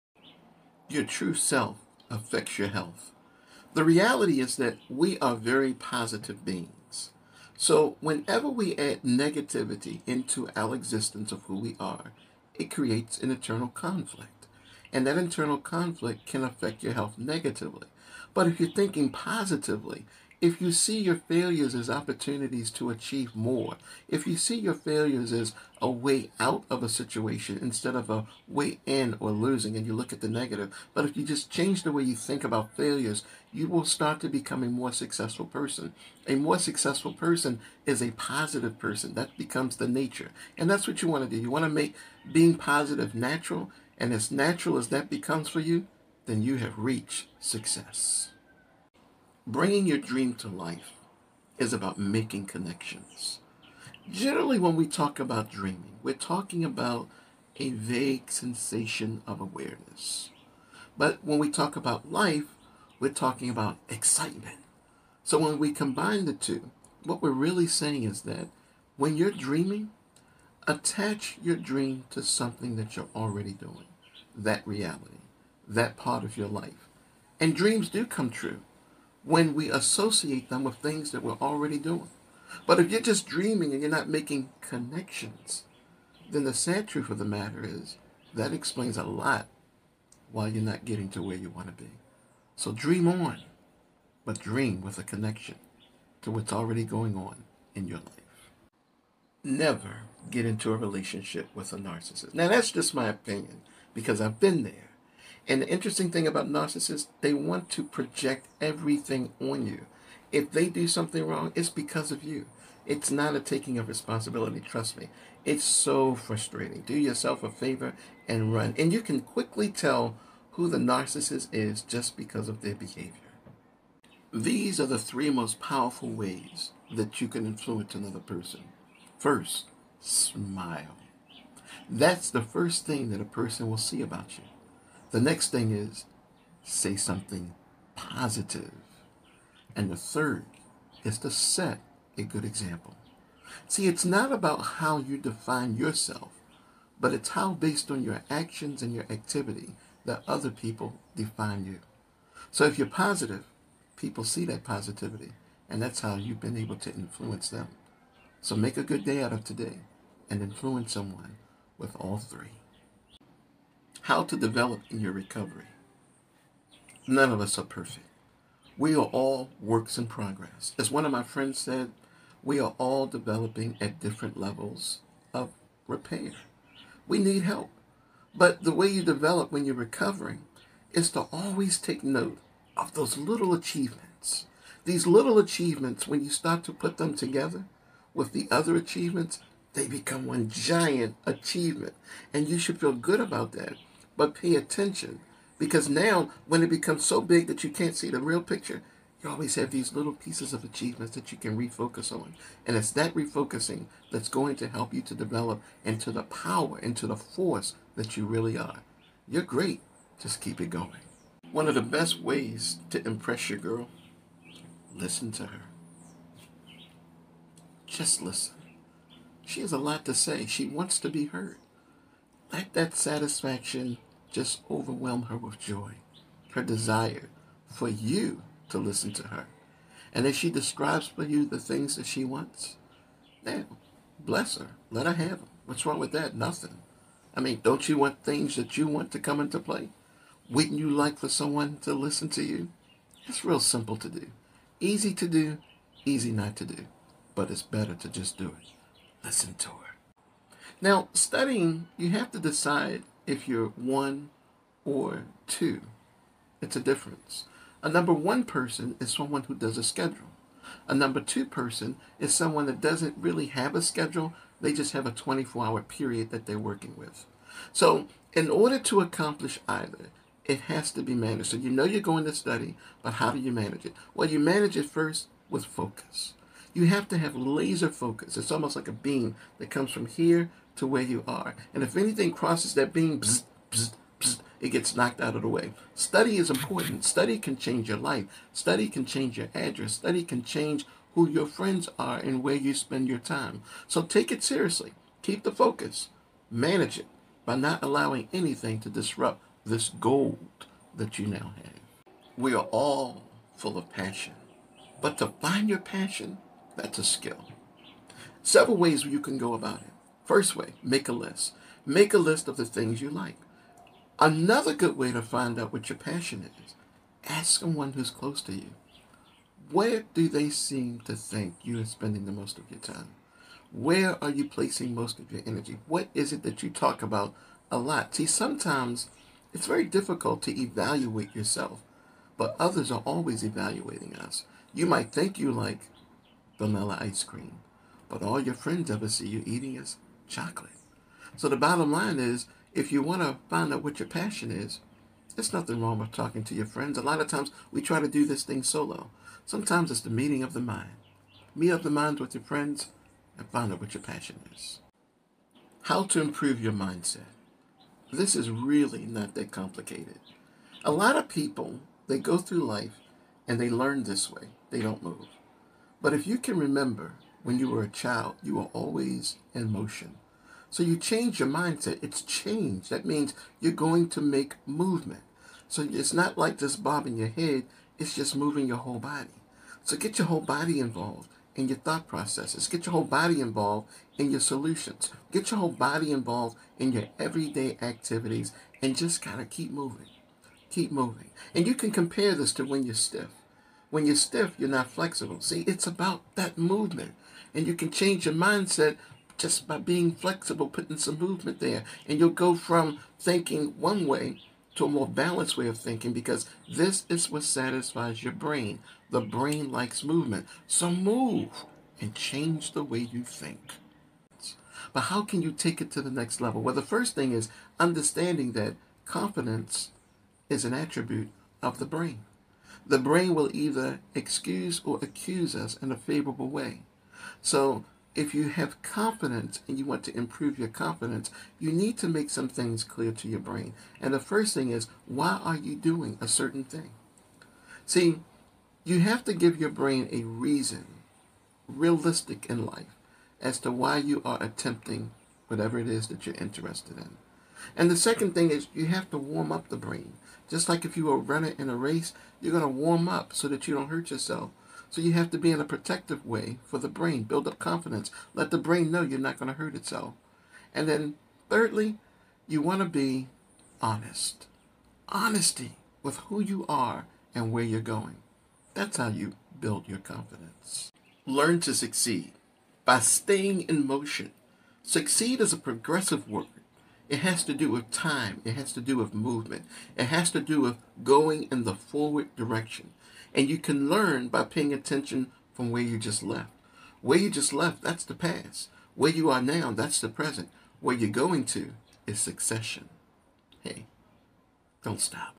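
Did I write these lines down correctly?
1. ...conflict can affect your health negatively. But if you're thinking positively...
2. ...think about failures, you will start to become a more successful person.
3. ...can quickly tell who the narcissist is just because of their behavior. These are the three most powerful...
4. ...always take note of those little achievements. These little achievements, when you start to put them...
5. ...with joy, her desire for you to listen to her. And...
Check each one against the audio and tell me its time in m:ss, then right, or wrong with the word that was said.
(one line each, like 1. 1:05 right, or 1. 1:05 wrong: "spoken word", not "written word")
1. 0:15 right
2. 0:32 right
3. 1:59 right
4. 3:01 right
5. 3:45 right.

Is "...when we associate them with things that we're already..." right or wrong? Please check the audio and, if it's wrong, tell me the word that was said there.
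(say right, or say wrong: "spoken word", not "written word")
right.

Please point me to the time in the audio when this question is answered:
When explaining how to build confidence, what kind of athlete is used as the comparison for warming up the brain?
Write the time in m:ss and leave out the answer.
7:31.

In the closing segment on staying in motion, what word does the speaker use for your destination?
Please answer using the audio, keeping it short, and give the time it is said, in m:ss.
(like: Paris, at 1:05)
succession, at 8:12.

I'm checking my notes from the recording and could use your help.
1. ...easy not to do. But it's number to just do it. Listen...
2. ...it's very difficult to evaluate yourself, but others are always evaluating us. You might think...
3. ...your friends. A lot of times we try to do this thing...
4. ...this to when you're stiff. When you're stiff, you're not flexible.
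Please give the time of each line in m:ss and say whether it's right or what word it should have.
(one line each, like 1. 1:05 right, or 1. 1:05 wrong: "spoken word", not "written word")
1. 4:06 wrong: "better", not "number"
2. 5:29 right
3. 5:46 right
4. 6:32 right.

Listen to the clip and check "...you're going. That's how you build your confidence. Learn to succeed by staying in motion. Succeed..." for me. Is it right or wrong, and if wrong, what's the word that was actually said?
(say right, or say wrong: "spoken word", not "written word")
right.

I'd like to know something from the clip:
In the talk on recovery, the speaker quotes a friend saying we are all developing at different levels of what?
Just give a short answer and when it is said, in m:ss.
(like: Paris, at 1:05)
repair, at 2:55.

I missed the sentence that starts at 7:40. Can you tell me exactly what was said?
And then thirdly, you want to be honest.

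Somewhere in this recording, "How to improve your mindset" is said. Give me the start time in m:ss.
5:55.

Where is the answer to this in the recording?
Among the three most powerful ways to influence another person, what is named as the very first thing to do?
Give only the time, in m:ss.
2:09.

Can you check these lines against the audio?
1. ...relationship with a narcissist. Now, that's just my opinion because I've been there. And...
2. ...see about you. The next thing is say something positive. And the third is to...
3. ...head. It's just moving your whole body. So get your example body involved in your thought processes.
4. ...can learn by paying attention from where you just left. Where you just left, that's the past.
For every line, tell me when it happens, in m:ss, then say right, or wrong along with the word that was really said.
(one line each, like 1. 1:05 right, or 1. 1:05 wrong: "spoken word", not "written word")
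1. 1:40 right
2. 2:13 right
3. 6:17 wrong: "whole", not "example"
4. 8:03 right.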